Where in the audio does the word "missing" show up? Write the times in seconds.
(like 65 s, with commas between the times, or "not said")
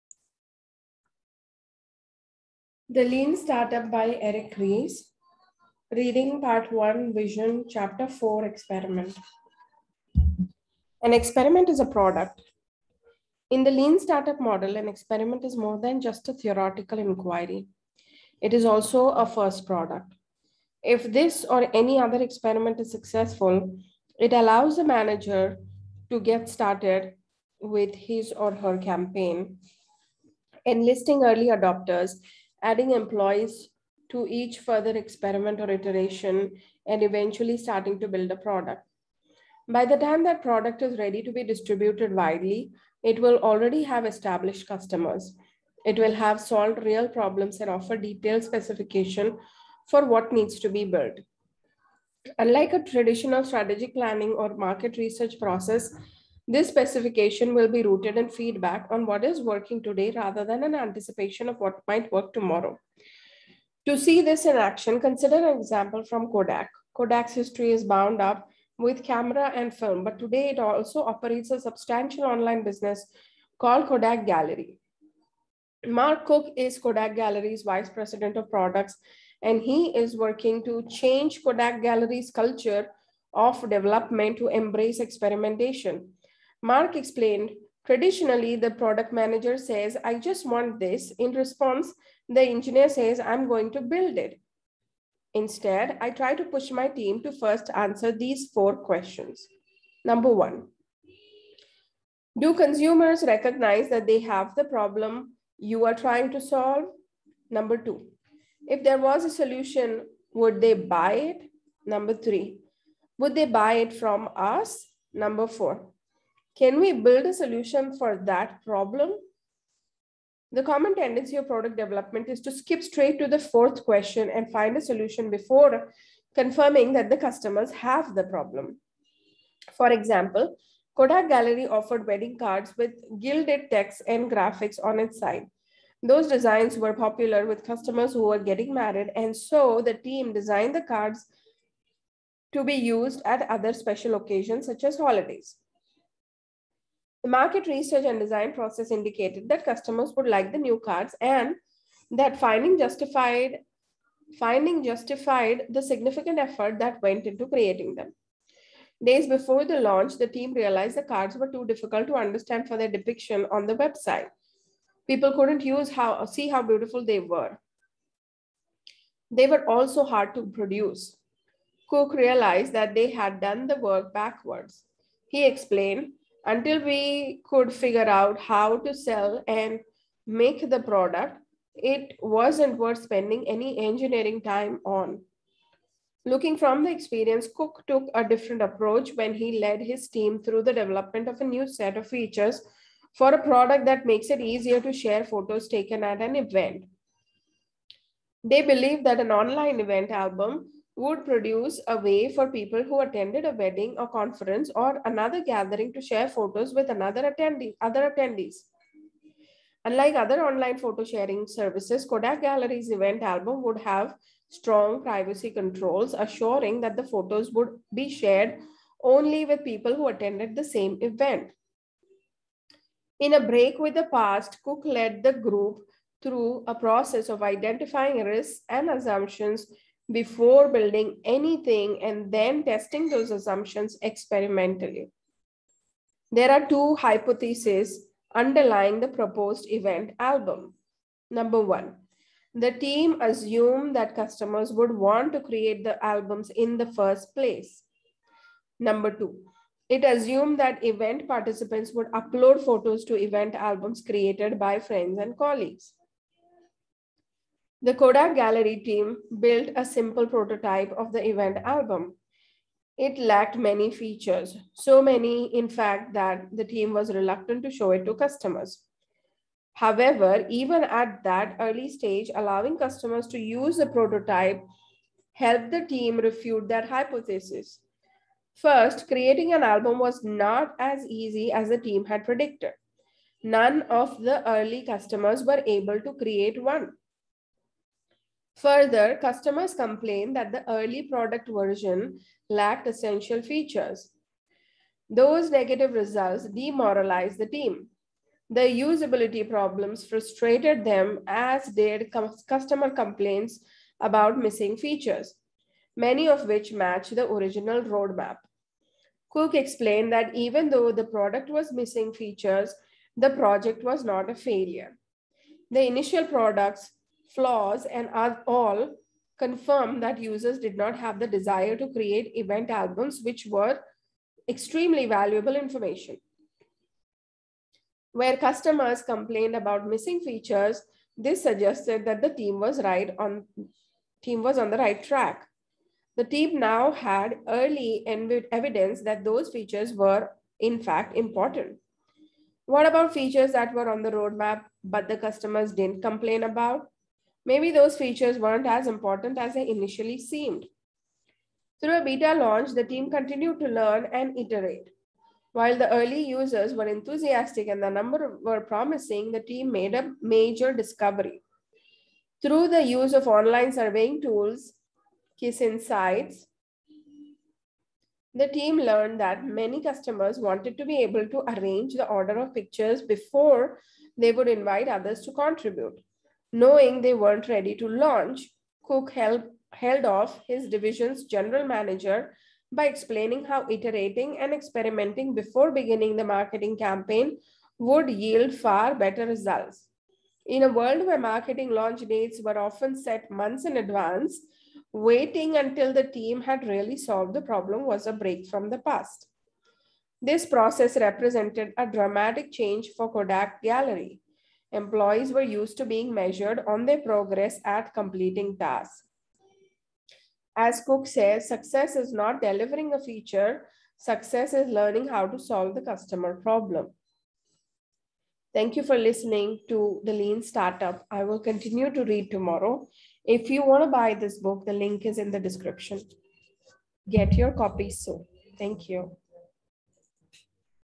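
304 s, 311 s, 329 s.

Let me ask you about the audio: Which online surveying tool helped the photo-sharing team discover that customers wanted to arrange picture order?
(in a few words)
Kiss Insights.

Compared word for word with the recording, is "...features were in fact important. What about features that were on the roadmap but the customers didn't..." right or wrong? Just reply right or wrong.
right.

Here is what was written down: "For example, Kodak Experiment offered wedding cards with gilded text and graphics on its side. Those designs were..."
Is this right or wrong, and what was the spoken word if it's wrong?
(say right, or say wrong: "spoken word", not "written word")
wrong: "Gallery", not "Experiment".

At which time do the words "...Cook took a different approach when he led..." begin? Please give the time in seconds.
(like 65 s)
187 s.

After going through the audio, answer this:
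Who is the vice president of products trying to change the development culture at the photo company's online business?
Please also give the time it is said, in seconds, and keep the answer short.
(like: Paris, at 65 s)
Mark Cook, at 75 s.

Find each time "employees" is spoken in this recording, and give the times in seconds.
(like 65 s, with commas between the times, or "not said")
32 s, 404 s.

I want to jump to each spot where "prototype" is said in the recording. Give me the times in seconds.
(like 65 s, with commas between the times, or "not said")
260 s, 273 s.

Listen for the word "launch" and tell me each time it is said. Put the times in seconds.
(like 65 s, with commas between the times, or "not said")
159 s, 352 s, 377 s, 391 s.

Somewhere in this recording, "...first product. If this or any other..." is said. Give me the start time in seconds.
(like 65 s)
19 s.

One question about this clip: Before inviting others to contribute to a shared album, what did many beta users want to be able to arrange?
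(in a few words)
The order of pictures.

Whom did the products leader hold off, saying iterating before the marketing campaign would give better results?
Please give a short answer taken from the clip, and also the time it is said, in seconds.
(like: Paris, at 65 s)
His division's general manager, at 381 s.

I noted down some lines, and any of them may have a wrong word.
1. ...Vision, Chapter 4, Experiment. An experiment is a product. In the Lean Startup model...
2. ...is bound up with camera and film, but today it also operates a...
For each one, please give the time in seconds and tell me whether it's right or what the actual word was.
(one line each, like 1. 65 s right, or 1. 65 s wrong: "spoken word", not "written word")
1. 7 s right
2. 67 s right.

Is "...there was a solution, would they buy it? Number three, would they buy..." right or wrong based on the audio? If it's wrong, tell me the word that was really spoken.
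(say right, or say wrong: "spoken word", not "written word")
right.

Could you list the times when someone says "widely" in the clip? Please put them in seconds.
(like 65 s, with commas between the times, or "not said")
42 s.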